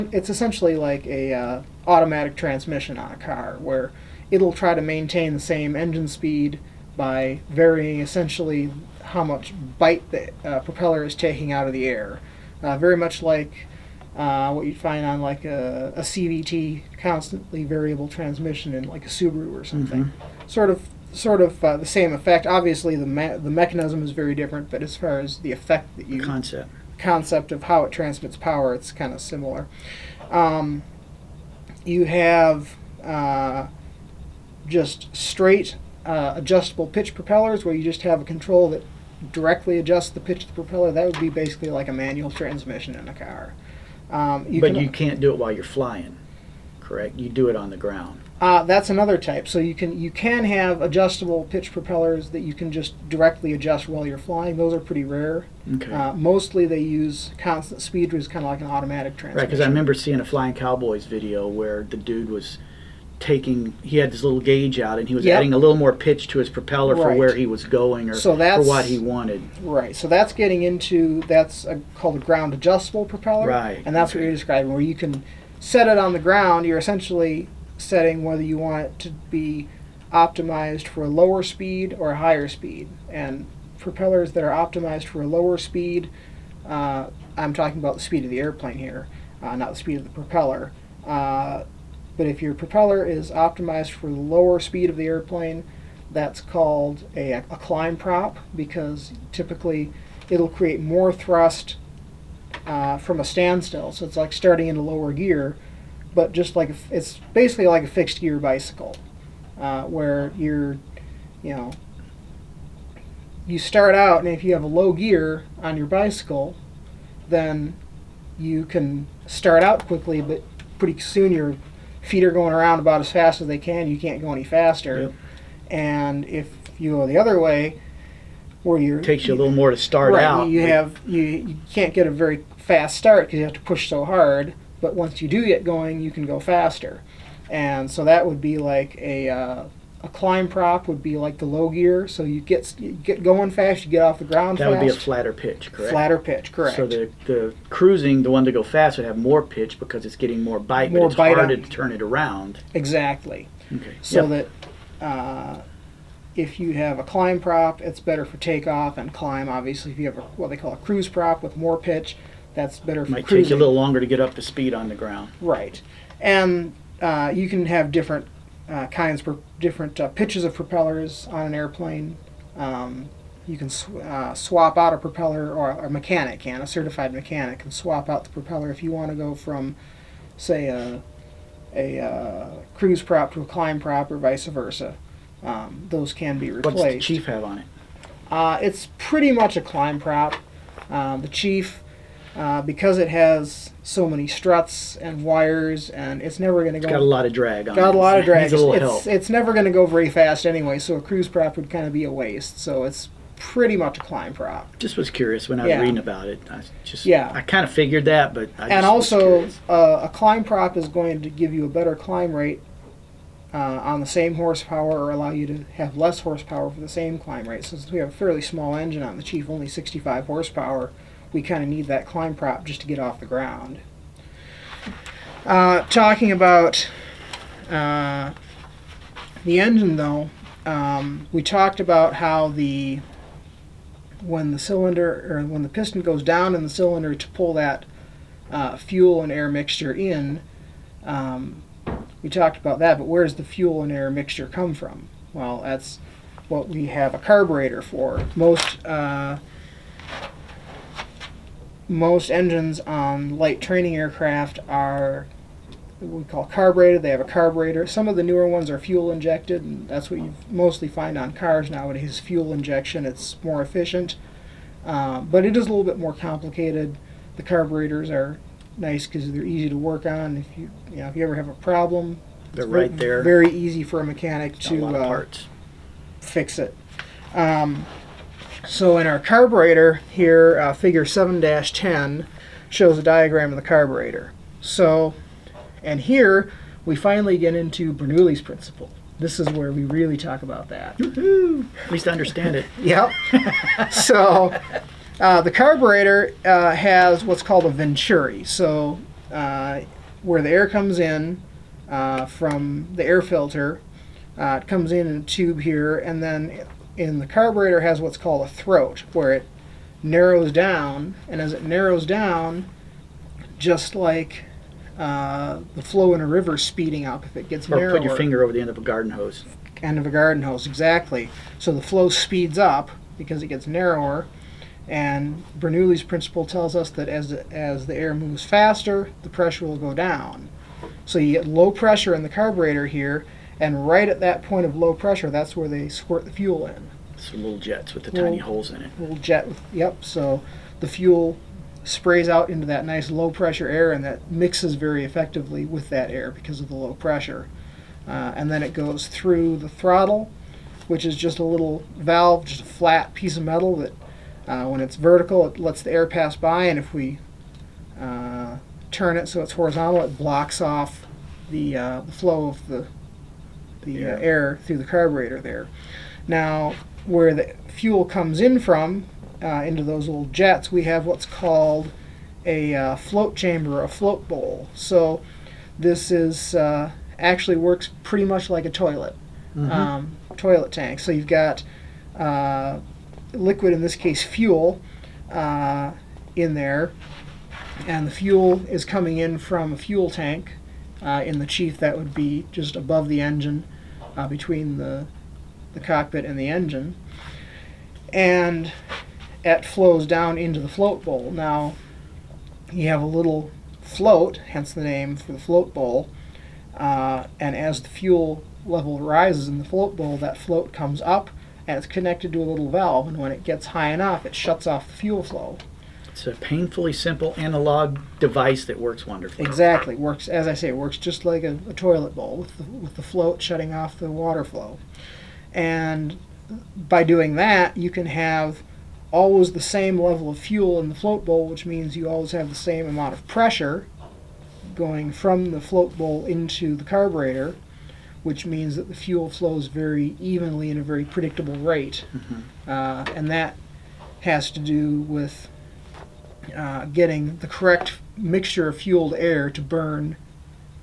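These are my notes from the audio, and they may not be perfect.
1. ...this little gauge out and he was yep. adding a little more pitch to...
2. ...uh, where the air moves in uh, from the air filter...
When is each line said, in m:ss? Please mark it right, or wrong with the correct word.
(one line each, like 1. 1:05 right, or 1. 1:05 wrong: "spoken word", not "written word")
1. 1:04 right
2. 4:59 wrong: "comes", not "moves".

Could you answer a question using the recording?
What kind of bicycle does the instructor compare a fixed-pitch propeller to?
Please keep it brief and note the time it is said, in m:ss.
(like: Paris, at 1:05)
fixed gear bicycle, at 1:47.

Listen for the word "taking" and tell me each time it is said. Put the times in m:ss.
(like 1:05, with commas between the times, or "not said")
0:11, 1:03.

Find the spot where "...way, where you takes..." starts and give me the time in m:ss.
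2:07.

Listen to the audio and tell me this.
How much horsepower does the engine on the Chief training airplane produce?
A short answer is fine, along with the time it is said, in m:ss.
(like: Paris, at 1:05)
65, at 3:39.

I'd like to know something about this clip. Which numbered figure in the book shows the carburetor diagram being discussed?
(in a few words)
7-10.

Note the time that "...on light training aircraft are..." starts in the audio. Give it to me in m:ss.
4:12.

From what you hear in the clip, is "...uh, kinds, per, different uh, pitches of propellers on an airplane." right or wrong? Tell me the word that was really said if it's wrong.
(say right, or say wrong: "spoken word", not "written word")
right.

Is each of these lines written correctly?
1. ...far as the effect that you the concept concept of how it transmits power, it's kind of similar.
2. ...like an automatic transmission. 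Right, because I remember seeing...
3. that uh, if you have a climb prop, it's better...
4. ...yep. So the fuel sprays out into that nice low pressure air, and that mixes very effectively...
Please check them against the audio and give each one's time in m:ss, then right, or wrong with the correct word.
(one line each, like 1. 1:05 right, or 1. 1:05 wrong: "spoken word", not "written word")
1. 0:24 right
2. 0:58 right
3. 2:34 right
4. 5:39 right.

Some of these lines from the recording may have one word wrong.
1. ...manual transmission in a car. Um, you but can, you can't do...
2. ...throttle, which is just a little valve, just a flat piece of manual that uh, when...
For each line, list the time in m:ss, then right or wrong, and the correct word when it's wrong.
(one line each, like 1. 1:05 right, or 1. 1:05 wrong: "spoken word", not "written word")
1. 0:41 right
2. 5:49 wrong: "metal", not "manual".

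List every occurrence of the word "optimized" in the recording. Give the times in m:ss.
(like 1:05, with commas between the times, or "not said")
1:20, 1:24, 1:33.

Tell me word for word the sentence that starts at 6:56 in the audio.
It's a painfully simple analog device that works wonderfully.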